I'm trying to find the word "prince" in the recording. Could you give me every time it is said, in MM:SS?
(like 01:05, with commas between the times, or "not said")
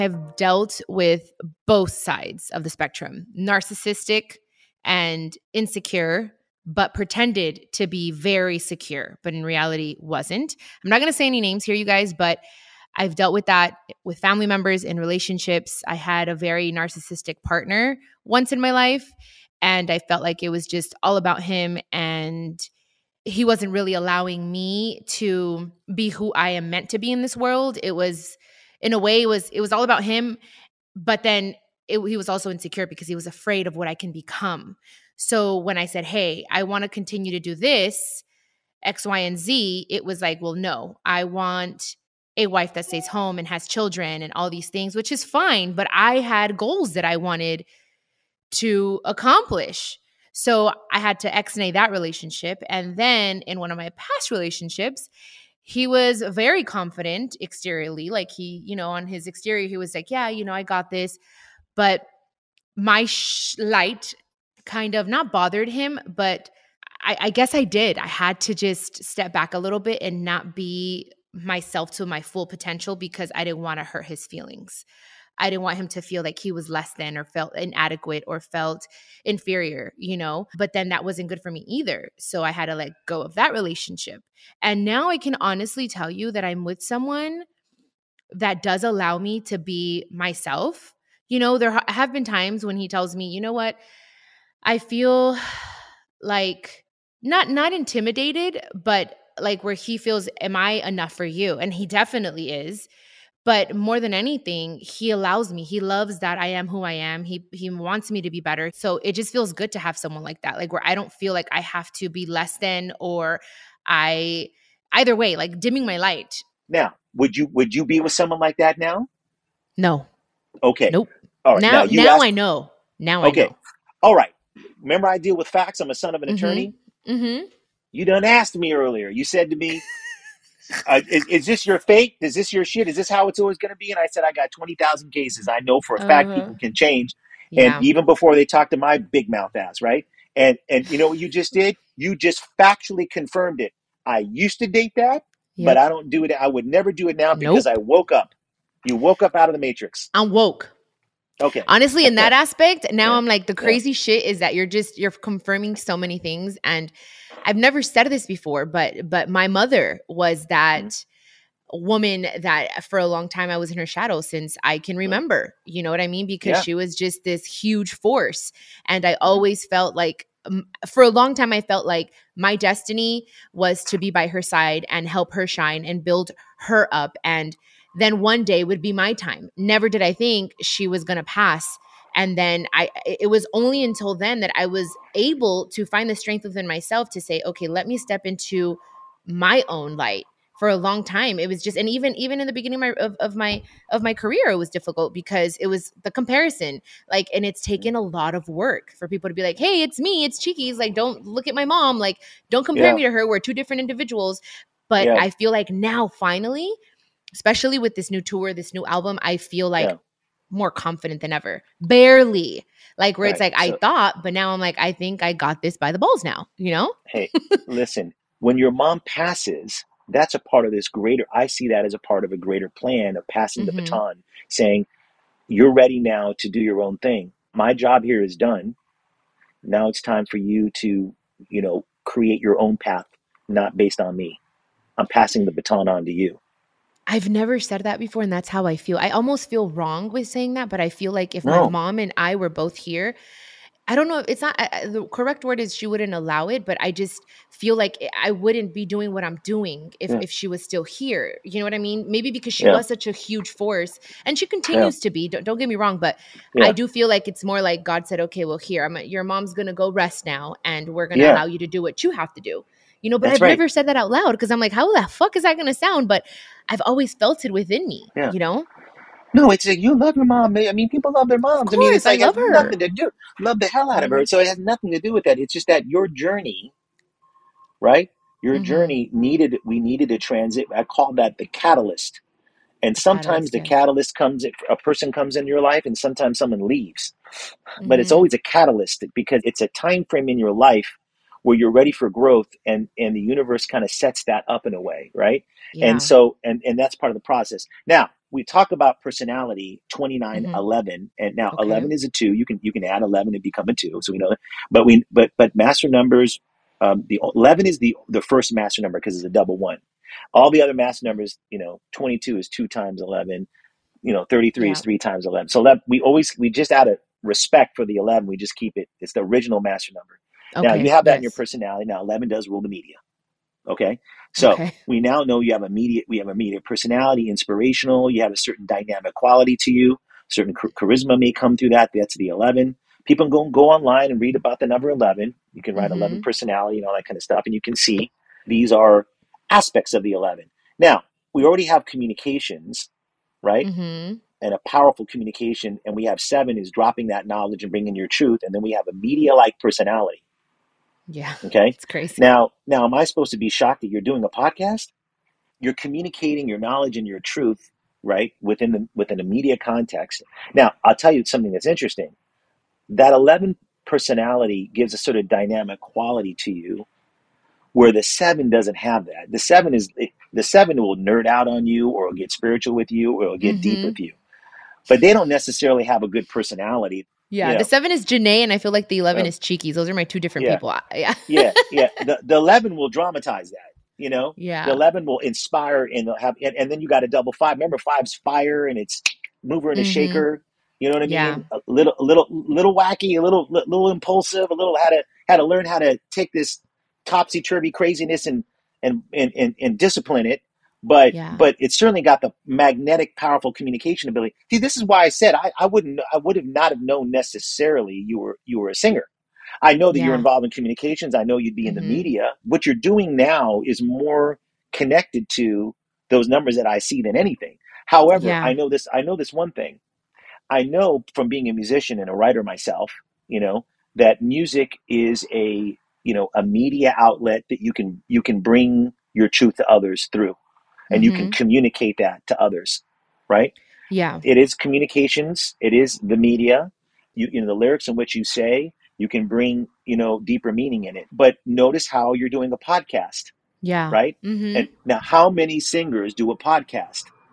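not said.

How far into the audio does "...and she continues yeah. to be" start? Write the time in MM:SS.
04:14.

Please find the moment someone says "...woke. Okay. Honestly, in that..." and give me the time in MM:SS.
02:30.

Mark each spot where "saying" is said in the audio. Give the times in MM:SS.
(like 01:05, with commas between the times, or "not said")
03:44, 04:00.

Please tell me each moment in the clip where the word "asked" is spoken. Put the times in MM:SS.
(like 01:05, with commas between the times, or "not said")
02:02, 02:08.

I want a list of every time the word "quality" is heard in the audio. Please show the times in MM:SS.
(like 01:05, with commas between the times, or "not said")
05:29, 06:05.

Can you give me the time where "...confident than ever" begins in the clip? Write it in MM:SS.
03:30.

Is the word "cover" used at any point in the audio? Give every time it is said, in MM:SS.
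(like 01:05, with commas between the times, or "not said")
not said.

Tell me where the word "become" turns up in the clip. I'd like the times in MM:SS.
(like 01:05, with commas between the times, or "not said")
00:34, 05:03.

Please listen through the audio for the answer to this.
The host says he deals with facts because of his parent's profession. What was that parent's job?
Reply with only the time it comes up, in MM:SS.
02:06.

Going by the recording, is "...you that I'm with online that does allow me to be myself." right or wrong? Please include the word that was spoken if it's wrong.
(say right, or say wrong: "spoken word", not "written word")
wrong: "someone", not "online".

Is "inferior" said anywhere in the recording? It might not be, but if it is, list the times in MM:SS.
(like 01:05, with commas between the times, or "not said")
01:19.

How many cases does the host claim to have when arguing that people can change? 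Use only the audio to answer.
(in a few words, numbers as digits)
20,000.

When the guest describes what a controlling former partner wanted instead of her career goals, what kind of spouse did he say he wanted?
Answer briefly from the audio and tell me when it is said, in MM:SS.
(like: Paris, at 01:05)
A wife that stays home, at 00:42.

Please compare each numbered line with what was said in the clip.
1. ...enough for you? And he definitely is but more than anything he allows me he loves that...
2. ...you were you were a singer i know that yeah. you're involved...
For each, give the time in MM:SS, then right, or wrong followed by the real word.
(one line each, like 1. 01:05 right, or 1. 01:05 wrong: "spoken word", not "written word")
1. 01:40 right
2. 06:48 right.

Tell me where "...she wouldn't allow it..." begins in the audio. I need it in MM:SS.
04:05.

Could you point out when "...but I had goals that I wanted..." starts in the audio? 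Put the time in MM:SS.
00:45.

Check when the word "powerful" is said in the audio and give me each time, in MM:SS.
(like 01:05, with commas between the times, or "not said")
05:44, 06:43.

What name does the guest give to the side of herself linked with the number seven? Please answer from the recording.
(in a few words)
Janney.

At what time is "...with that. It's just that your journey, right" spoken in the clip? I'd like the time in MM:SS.
04:35.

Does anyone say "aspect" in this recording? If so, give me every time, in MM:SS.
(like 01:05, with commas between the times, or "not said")
02:32, 05:39.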